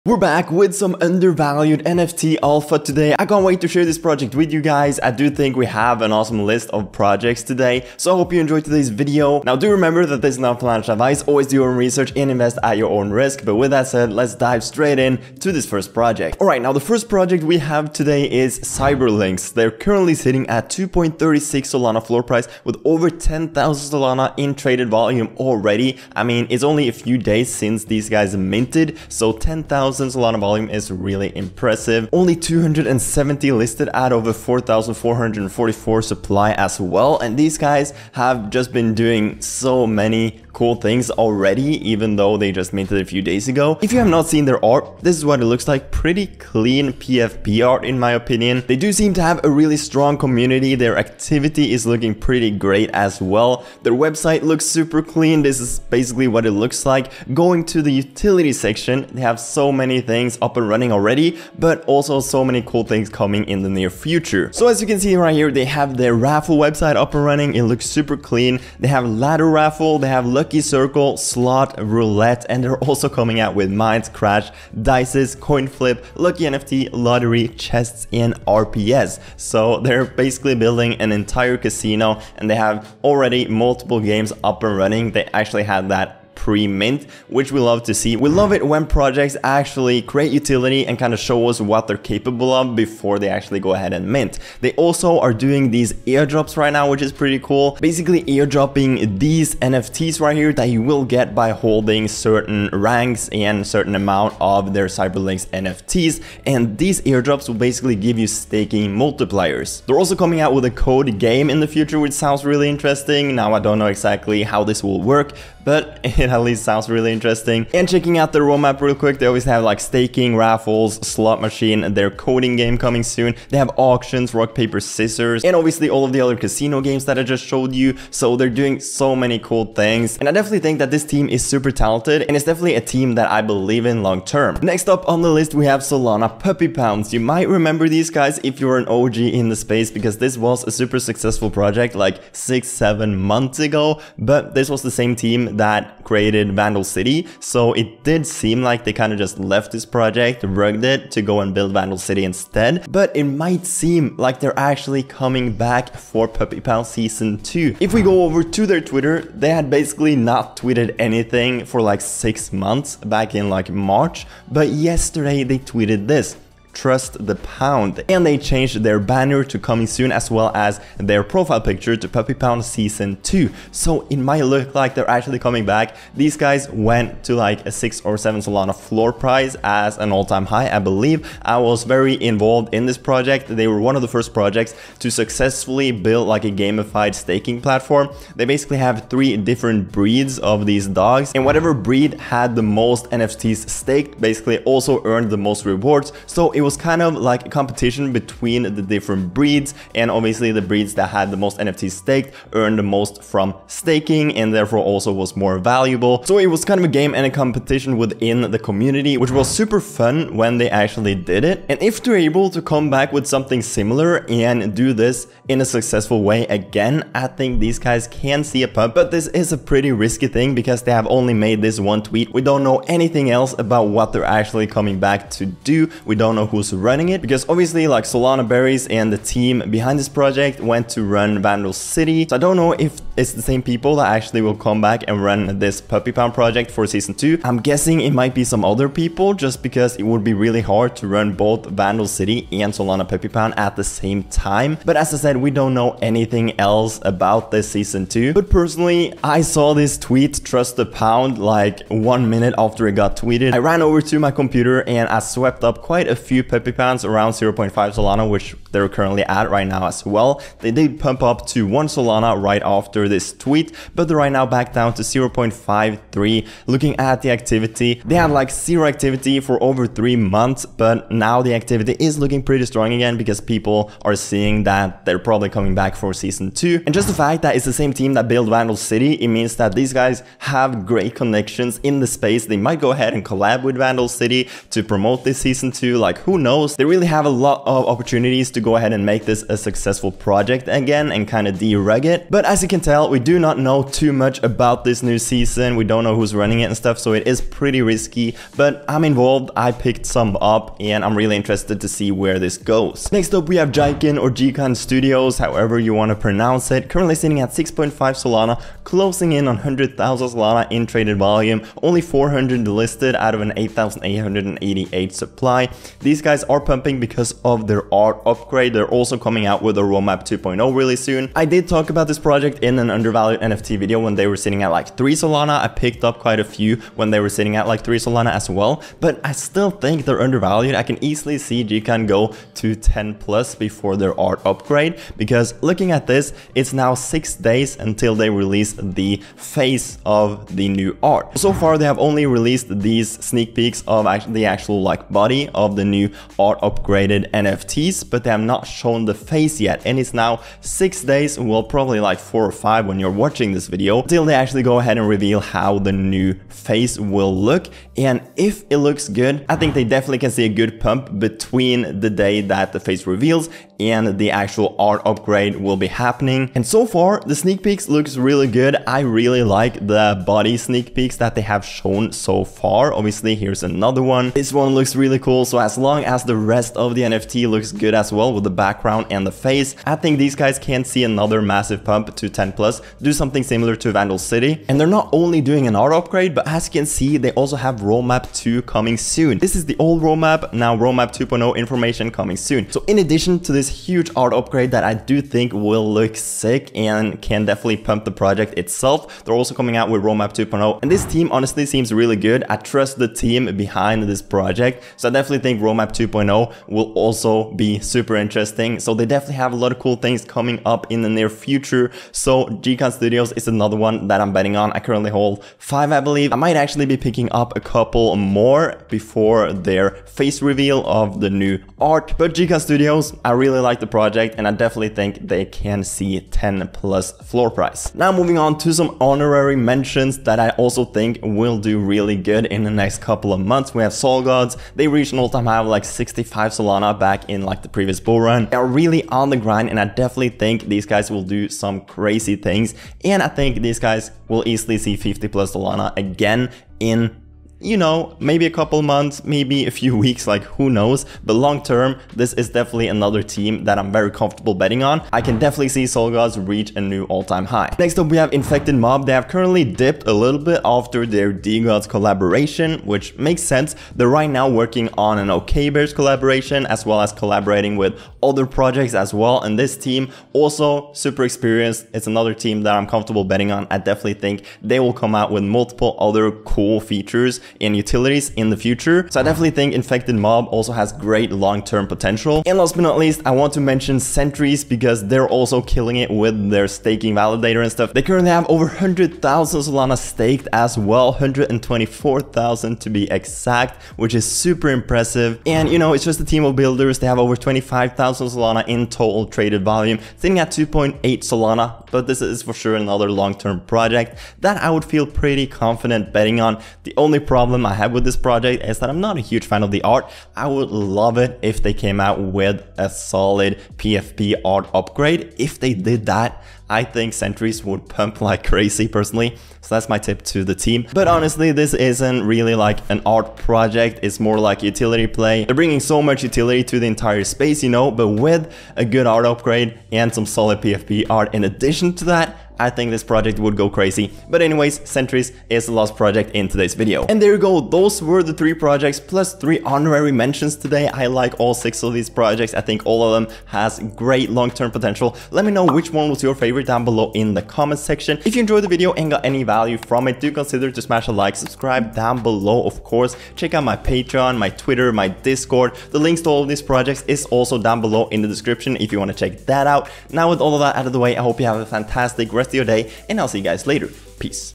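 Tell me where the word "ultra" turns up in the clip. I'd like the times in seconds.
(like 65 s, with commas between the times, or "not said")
not said.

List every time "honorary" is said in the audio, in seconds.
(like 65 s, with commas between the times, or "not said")
428 s, 539 s.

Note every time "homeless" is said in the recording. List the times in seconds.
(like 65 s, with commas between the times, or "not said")
not said.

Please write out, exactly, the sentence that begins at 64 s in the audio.
So as you can see right here, they have their raffle website up and running.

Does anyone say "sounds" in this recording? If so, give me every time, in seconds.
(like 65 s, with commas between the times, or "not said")
112 s, 116 s.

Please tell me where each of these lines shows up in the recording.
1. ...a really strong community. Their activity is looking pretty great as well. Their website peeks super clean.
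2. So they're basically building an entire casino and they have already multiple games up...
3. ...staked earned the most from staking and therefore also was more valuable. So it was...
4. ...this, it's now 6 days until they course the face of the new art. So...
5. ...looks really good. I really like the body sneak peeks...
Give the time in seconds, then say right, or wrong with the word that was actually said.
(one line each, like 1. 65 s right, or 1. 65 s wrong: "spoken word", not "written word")
1. 49 s wrong: "looks", not "peeks"
2. 79 s right
3. 201 s right
4. 336 s wrong: "release", not "course"
5. 367 s right.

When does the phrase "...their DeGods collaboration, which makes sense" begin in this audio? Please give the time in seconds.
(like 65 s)
461 s.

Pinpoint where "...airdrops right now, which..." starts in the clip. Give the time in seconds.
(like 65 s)
96 s.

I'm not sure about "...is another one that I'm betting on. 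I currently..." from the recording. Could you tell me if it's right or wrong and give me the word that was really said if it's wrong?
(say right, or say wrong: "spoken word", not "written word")
right.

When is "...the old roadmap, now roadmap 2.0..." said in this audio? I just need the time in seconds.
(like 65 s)
389 s.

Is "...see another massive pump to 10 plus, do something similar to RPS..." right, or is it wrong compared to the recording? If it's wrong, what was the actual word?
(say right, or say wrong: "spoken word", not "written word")
wrong: "Vandal", not "RPS".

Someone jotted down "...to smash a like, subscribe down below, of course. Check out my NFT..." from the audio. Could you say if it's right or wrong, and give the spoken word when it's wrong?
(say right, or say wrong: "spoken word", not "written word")
wrong: "Patreon", not "NFT".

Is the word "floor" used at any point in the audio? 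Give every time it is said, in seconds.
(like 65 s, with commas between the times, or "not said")
22 s, 178 s, 427 s.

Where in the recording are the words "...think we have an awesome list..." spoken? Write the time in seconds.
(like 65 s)
5 s.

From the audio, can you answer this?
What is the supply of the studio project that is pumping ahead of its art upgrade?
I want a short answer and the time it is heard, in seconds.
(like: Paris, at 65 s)
8,888, at 313 s.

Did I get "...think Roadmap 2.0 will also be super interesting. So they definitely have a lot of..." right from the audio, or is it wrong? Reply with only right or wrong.
right.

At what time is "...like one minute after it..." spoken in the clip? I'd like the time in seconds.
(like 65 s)
251 s.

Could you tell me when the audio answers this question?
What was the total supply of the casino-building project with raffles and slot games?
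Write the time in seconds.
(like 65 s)
34 s.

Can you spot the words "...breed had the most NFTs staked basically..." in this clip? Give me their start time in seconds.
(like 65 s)
191 s.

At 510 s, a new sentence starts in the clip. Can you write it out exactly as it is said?
I would love it if they came out with a solid PFP art upgrade.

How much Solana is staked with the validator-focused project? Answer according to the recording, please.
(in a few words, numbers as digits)
124,000.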